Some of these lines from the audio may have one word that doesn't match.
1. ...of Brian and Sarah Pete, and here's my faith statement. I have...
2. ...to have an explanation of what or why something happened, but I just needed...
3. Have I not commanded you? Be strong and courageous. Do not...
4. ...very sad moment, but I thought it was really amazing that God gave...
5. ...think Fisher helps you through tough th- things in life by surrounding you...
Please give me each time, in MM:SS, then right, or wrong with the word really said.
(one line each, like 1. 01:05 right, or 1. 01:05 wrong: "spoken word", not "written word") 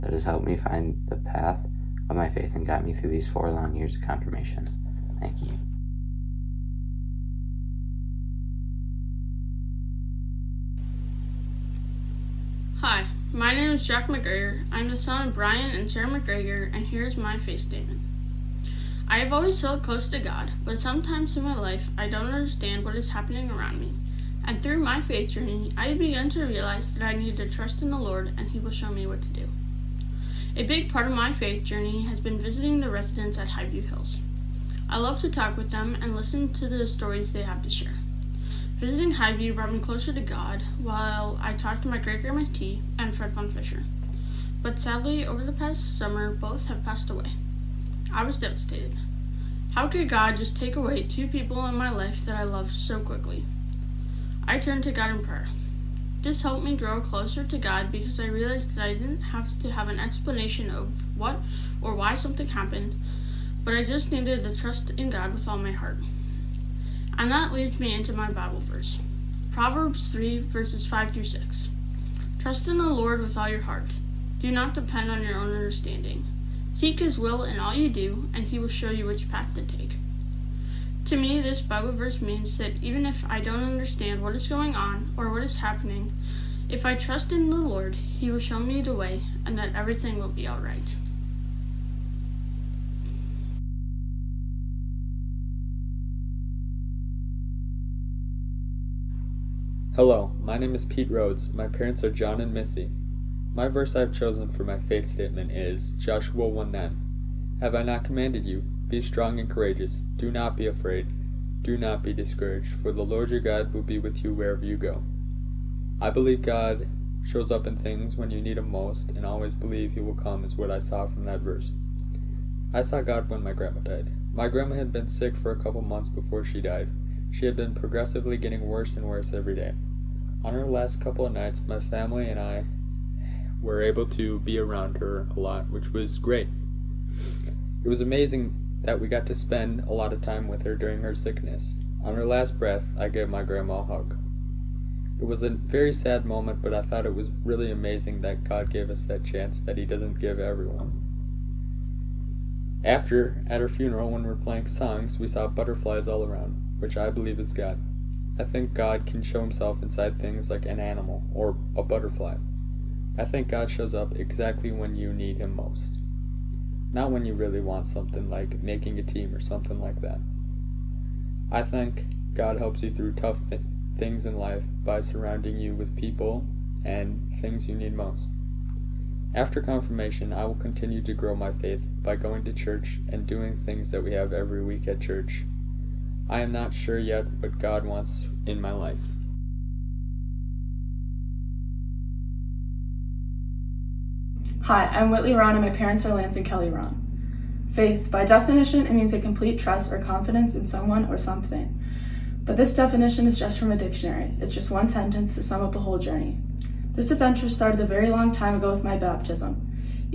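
1. 00:15 wrong: "McGregor", not "Pete"
2. 00:59 right
3. 01:47 right
4. 02:25 right
5. 02:51 wrong: "God", not "Fisher".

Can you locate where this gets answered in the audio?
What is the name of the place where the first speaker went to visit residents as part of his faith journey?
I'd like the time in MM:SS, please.
00:33.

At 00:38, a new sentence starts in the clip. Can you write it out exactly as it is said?
Visiting Highview brought me closer to God while I talked to my great grandma T and Fred von Fisher.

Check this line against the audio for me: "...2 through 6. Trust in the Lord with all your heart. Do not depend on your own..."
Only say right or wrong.
wrong.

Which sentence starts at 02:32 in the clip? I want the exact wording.
After, at her funeral, when we were playing songs, we saw butterflies all around, which I believe is God.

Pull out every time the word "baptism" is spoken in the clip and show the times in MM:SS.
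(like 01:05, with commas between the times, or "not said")
03:28.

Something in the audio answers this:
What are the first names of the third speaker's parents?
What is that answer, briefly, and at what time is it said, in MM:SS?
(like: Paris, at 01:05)
Lance and Kelly, at 03:16.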